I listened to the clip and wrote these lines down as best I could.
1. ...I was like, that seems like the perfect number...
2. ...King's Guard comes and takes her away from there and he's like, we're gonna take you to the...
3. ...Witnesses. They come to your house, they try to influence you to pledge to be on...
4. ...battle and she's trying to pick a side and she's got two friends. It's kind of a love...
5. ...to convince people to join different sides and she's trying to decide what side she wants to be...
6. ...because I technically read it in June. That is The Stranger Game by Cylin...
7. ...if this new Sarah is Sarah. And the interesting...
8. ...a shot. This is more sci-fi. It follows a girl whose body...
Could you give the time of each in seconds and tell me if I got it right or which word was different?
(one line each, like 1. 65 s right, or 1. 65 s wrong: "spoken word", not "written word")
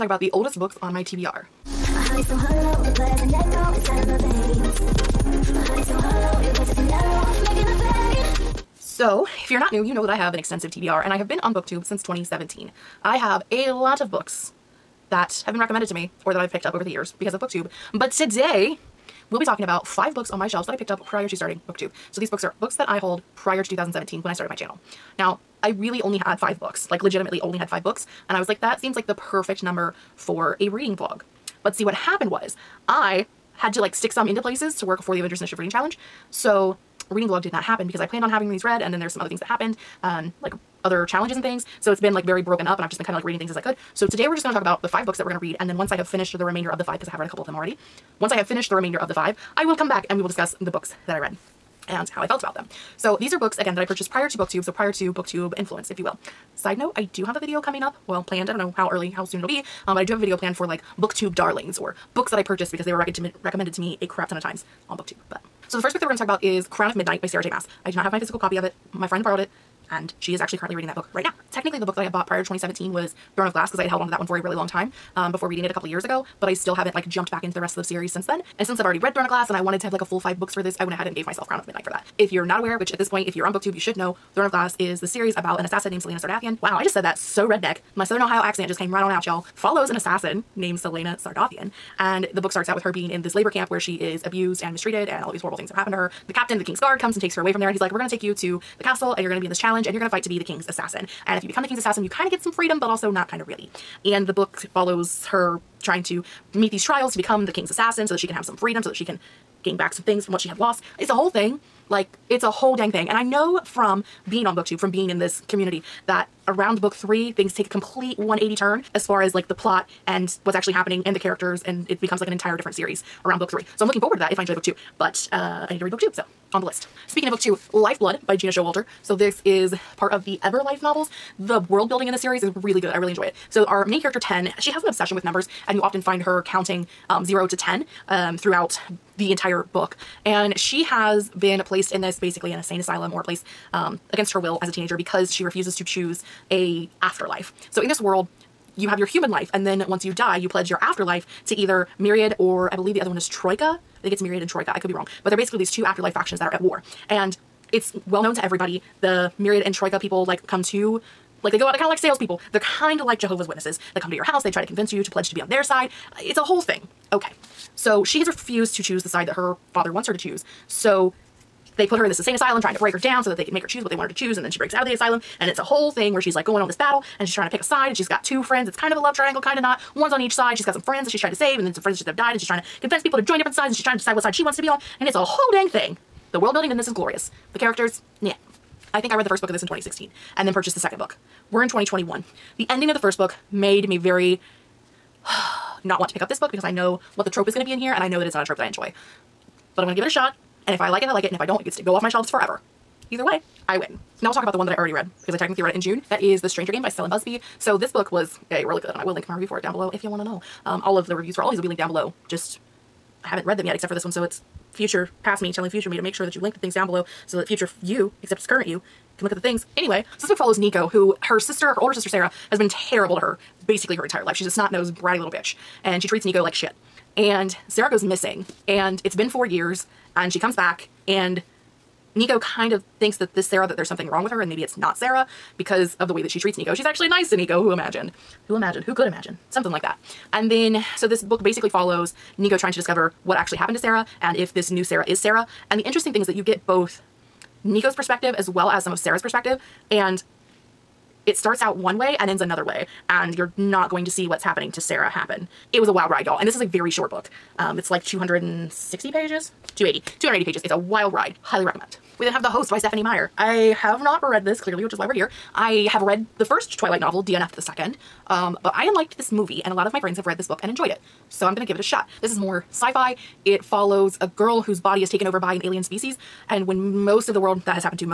1. 28 s right
2. 96 s right
3. 163 s wrong: "convince", not "influence"
4. 176 s right
5. 182 s right
6. 205 s right
7. 244 s right
8. 271 s right.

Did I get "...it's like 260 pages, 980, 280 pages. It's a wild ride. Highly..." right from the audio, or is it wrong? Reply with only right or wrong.
wrong.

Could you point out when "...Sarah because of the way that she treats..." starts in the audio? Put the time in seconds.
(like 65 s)
234 s.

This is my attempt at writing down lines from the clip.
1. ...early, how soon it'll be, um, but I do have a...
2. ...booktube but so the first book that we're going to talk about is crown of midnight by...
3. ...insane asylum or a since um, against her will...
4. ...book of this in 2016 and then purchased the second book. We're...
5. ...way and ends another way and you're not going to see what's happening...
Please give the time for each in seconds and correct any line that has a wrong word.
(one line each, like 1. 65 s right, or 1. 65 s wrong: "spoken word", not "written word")
1. 58 s right
2. 64 s right
3. 142 s wrong: "place", not "since"
4. 189 s right
5. 251 s right.